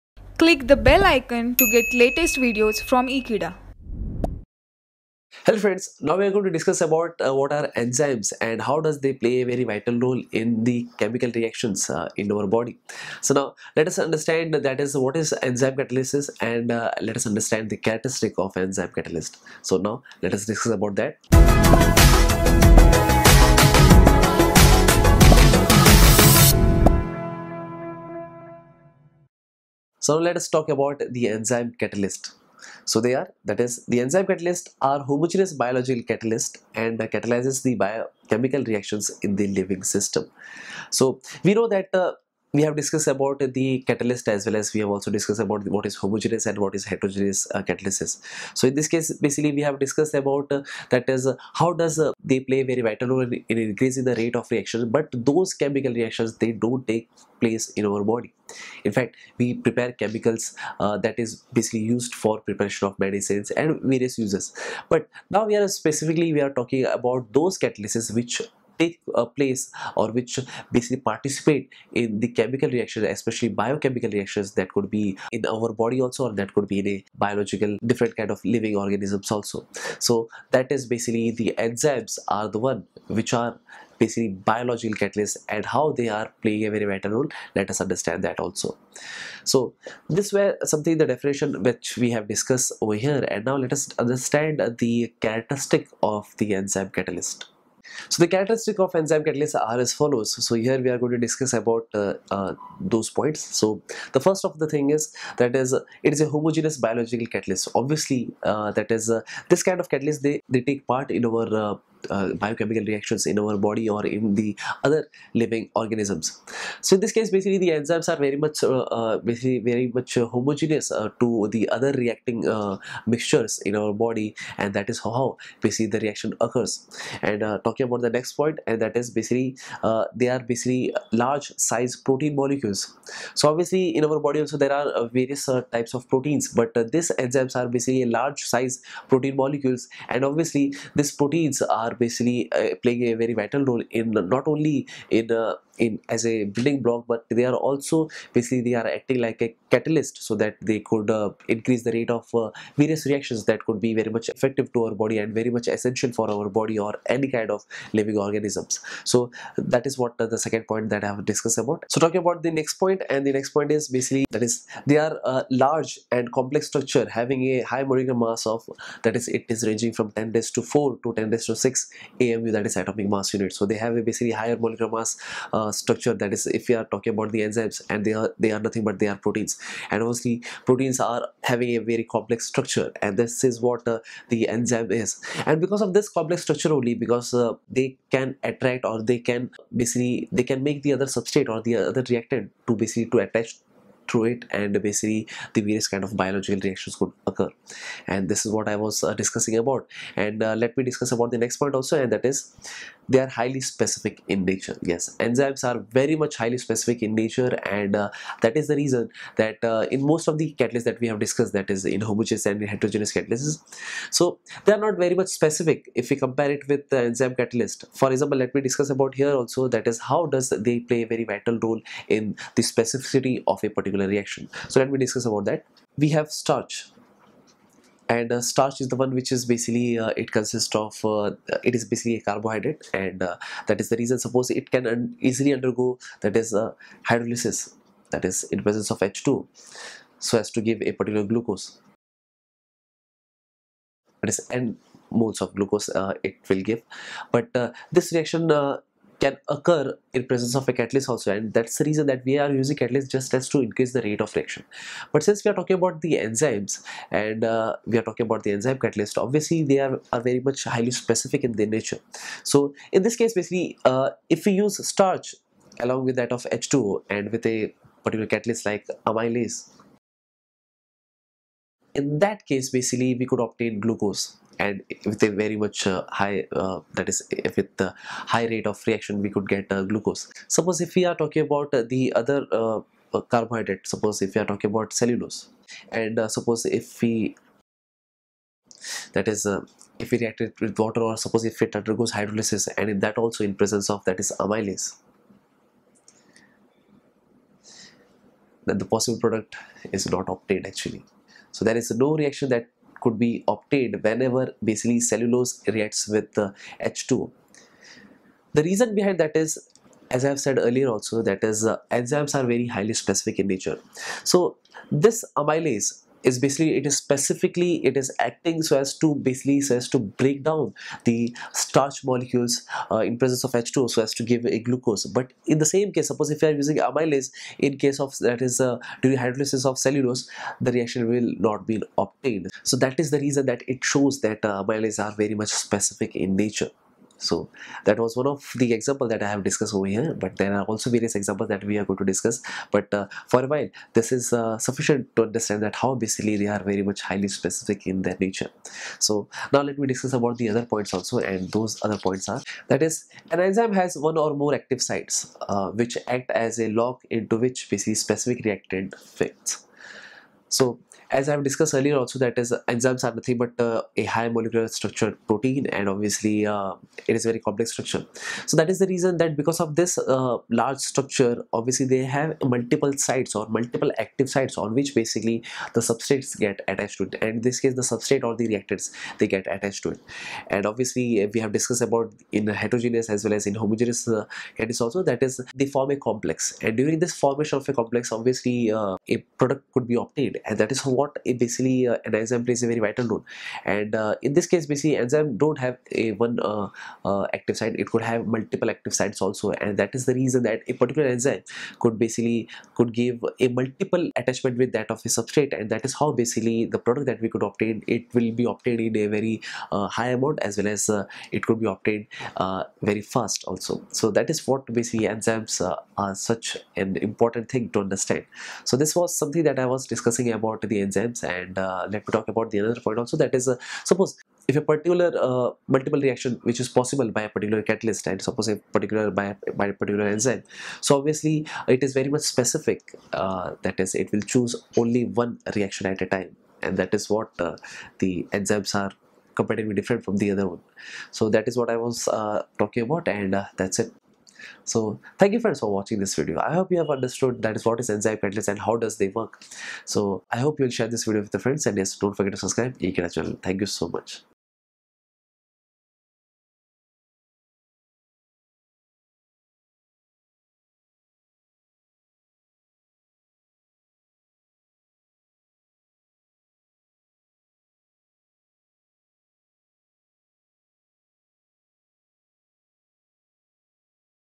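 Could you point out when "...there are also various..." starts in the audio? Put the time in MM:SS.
05:40.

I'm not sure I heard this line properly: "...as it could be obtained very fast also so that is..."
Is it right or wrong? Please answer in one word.
right.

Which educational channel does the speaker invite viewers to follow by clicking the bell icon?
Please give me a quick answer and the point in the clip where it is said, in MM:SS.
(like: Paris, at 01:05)
Ekeeda, at 00:03.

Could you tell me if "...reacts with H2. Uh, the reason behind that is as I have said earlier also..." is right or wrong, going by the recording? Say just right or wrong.
right.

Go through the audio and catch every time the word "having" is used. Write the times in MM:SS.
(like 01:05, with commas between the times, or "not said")
02:47, 03:01.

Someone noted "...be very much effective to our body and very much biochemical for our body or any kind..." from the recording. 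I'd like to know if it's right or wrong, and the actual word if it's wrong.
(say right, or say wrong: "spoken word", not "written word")
wrong: "essential", not "biochemical".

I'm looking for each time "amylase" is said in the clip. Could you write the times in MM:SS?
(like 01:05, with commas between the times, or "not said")
04:29, 04:54, 05:15, 05:26, 05:34.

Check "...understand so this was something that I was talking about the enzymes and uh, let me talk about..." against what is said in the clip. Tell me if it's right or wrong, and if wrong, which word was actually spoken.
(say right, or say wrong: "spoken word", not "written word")
wrong: "discussing", not "talking".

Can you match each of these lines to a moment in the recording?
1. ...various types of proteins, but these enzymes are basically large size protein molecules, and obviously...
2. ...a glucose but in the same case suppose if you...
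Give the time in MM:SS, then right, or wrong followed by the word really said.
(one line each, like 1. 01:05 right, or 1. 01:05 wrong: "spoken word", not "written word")
1. 02:15 right
2. 05:24 right.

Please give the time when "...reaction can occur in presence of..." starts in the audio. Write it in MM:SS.
04:08.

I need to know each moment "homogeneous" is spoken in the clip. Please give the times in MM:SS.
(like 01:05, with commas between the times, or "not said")
00:35, 00:45, 01:46, 02:00, 03:32, 06:23.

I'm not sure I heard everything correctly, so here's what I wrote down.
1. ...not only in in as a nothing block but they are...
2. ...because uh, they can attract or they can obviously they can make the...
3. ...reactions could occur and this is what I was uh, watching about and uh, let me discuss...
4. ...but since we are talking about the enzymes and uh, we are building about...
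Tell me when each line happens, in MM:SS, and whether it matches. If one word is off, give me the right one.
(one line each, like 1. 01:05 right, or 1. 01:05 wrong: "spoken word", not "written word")
1. 02:24 wrong: "building", not "nothing"
2. 03:06 wrong: "basically", not "obviously"
3. 03:16 wrong: "discussing", not "watching"
4. 04:15 wrong: "talking", not "building".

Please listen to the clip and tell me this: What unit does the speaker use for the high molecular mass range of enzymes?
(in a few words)
amu.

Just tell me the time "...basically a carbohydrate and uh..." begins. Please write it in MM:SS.
03:51.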